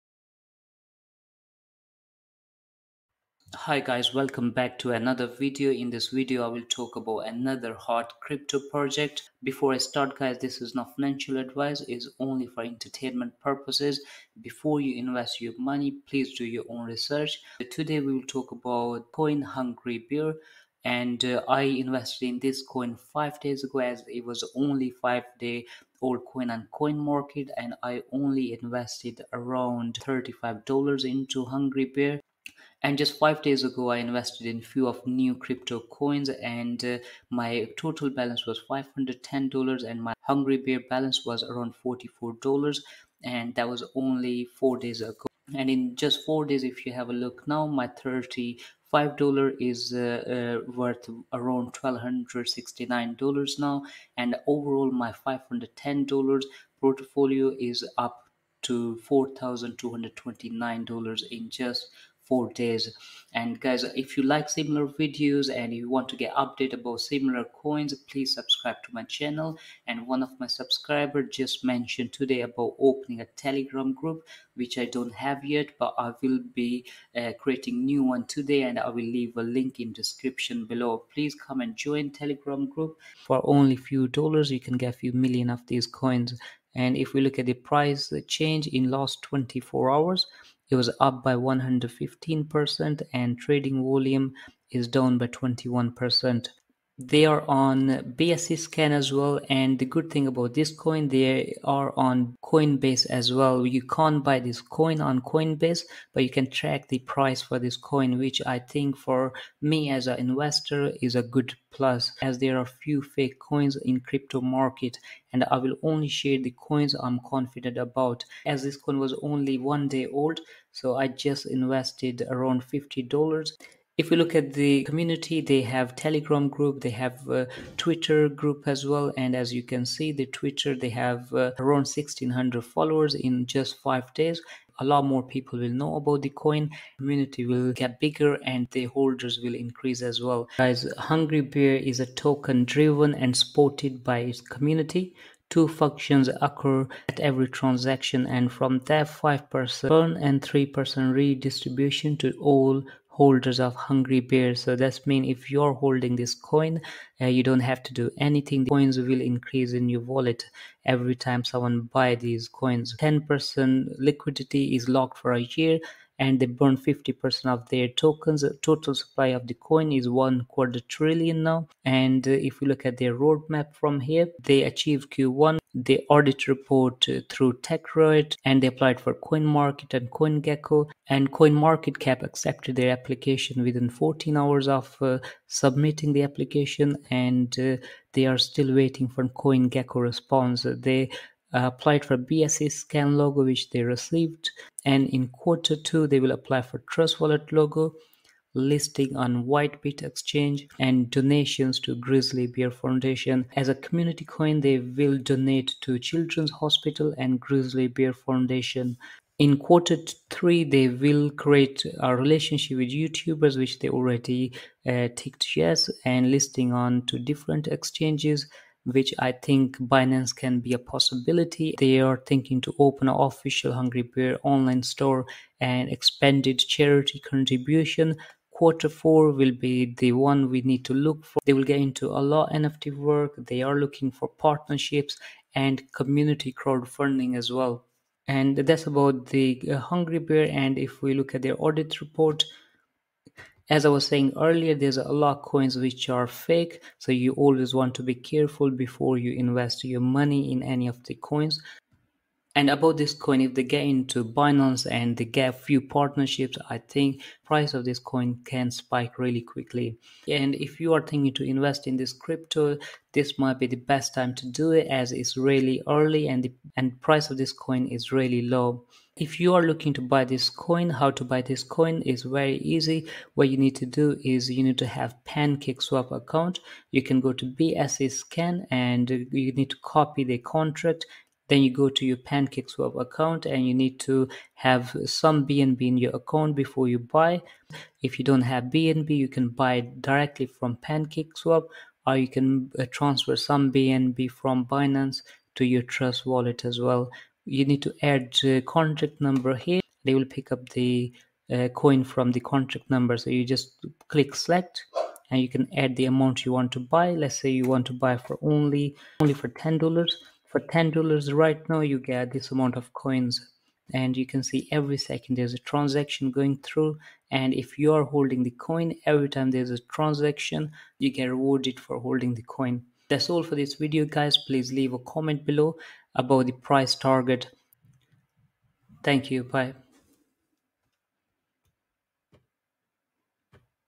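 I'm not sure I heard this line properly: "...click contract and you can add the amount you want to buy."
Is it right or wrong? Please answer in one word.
wrong.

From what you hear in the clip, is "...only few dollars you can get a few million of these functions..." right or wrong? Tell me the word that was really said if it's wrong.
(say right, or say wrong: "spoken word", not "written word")
wrong: "coins", not "functions".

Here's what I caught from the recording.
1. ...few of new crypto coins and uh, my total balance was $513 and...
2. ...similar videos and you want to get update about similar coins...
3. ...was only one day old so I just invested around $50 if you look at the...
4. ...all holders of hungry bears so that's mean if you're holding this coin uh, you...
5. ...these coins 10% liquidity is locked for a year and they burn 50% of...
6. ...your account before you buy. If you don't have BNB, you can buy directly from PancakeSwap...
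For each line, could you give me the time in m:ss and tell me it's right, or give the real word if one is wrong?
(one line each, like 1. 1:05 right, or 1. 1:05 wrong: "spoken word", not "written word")
1. 0:34 wrong: "510", not "513"
2. 1:04 right
3. 1:58 right
4. 2:32 right
5. 2:42 right
6. 4:45 right.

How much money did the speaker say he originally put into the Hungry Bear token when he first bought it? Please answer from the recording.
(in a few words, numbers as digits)
$35.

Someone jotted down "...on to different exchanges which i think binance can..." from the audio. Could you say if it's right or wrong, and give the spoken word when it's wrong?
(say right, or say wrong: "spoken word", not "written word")
right.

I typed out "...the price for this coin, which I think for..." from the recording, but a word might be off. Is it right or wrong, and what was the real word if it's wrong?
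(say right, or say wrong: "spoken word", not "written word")
right.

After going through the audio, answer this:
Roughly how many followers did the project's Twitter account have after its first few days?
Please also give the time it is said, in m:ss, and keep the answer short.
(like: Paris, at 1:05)
1,600, at 2:11.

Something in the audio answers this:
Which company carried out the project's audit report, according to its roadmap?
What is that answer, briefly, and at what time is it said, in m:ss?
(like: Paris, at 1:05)
TechRate, at 2:57.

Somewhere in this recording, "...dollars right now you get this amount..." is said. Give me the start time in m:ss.
5:10.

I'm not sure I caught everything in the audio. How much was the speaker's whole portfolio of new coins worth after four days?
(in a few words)
$4,229.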